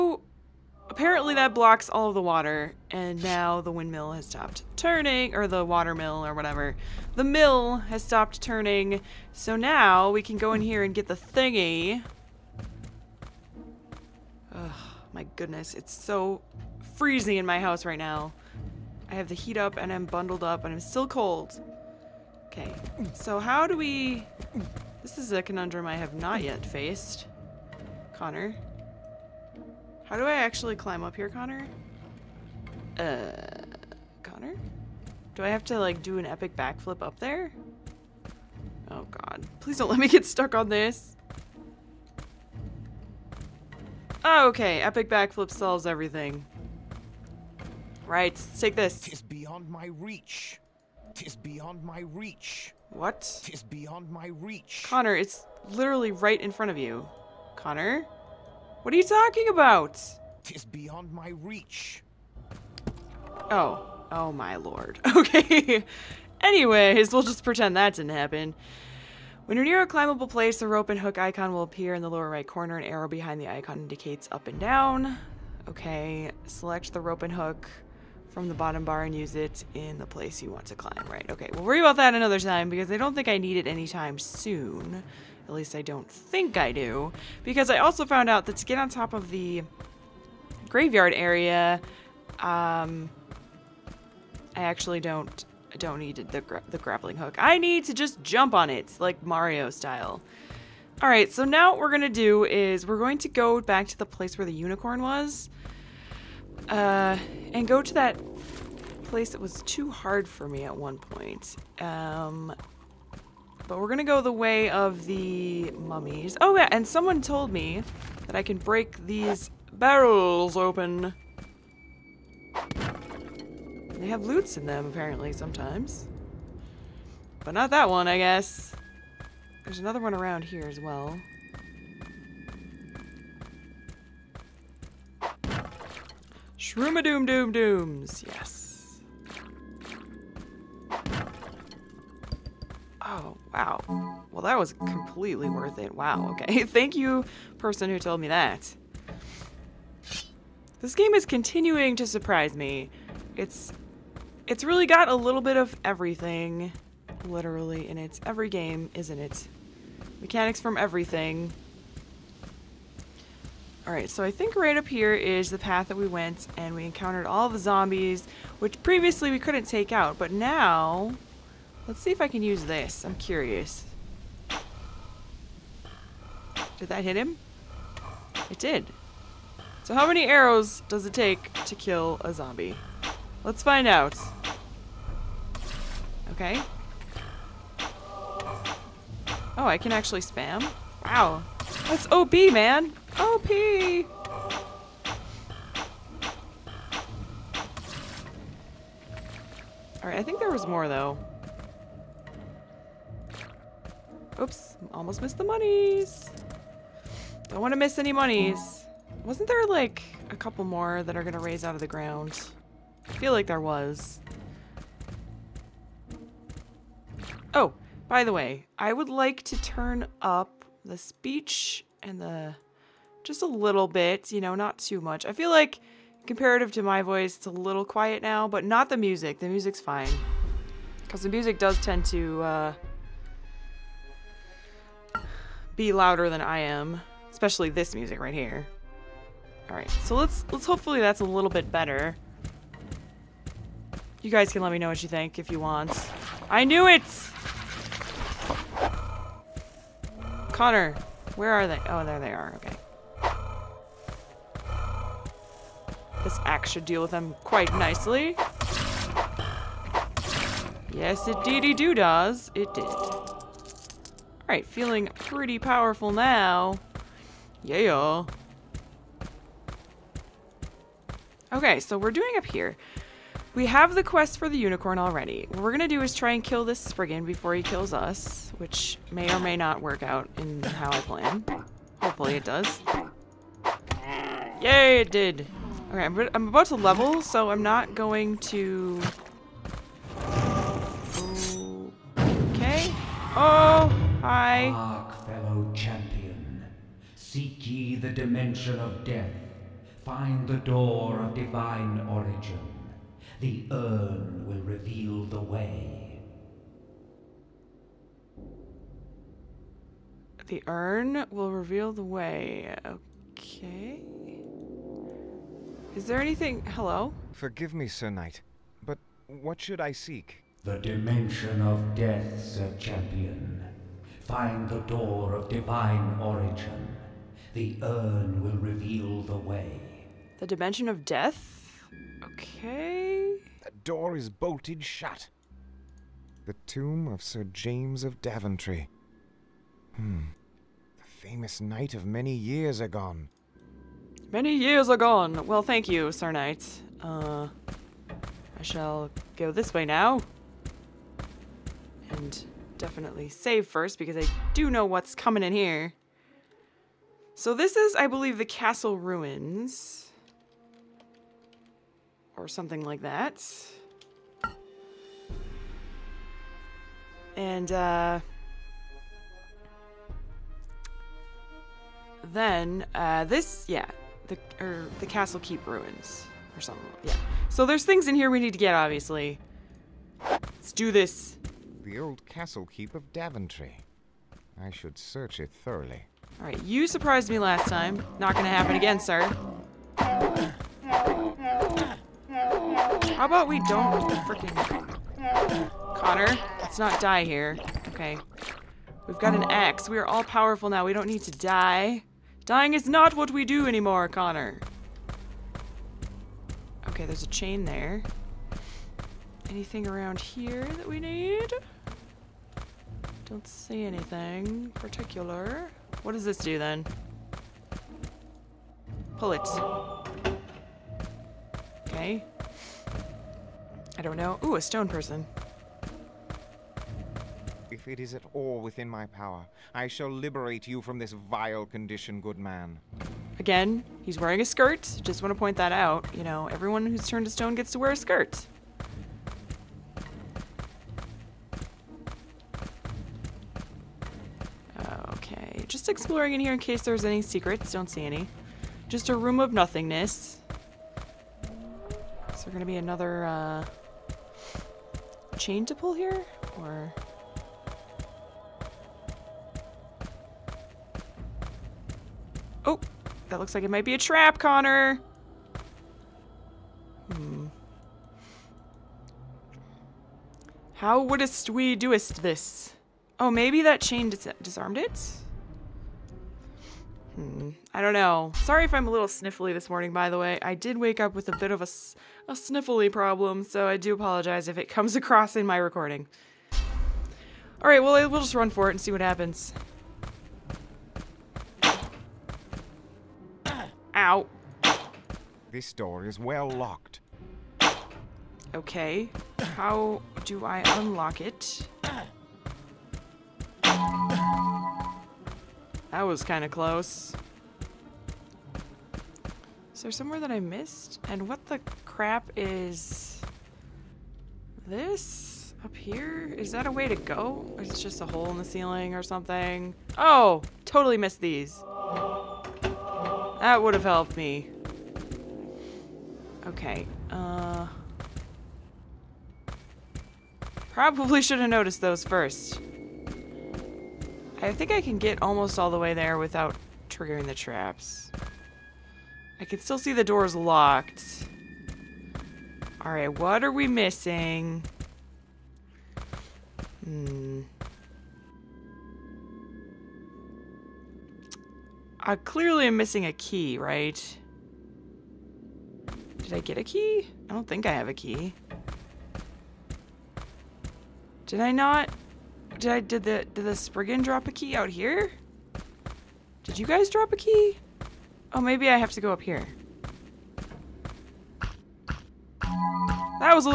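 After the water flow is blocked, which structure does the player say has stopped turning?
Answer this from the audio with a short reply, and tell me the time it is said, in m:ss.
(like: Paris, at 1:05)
The mill, at 0:07.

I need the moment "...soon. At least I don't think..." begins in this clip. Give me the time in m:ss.
1:24.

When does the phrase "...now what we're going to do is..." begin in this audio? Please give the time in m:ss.
1:41.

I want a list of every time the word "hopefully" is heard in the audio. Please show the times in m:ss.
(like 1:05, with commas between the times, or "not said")
4:00, 4:42.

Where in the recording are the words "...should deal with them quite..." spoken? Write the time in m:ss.
4:16.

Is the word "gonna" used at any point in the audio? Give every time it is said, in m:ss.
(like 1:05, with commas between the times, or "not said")
4:35, 6:28.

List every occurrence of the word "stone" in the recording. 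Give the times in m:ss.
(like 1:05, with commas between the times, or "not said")
7:04, 7:17.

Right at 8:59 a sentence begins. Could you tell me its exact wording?
I can still see the doors locked.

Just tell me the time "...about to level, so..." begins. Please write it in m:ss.
4:46.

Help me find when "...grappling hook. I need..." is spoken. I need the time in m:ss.
1:36.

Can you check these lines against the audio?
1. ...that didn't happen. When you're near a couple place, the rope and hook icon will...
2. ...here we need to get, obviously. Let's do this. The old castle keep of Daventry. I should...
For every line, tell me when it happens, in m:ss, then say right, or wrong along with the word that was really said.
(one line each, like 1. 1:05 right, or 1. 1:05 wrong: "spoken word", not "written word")
1. 1:07 wrong: "climbable", not "couple"
2. 6:18 right.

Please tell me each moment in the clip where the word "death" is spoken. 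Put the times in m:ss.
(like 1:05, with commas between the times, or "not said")
4:59, 5:21, 5:31.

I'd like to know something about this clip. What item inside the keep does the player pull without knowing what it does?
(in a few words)
A chain.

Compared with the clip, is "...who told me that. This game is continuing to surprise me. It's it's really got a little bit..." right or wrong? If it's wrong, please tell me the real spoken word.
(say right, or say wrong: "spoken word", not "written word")
right.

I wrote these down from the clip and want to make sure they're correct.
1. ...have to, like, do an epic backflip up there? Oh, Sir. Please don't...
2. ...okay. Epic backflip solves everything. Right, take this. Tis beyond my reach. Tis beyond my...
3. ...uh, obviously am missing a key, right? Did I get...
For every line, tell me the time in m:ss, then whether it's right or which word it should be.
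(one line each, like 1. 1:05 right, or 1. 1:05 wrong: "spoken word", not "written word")
1. 0:35 wrong: "God", not "Sir"
2. 0:44 right
3. 9:12 wrong: "clearly", not "obviously".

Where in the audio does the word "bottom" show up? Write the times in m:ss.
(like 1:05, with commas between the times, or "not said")
1:18.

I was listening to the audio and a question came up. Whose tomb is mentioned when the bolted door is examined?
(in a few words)
Sir James of Daventry.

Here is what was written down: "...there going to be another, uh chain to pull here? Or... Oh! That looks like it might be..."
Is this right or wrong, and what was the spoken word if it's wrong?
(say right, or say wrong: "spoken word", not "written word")
right.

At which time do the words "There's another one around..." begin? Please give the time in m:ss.
2:09.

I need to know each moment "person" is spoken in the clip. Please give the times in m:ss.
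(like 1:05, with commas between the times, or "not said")
2:27, 7:04.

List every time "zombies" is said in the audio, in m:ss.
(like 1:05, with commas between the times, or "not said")
2:47, 3:02.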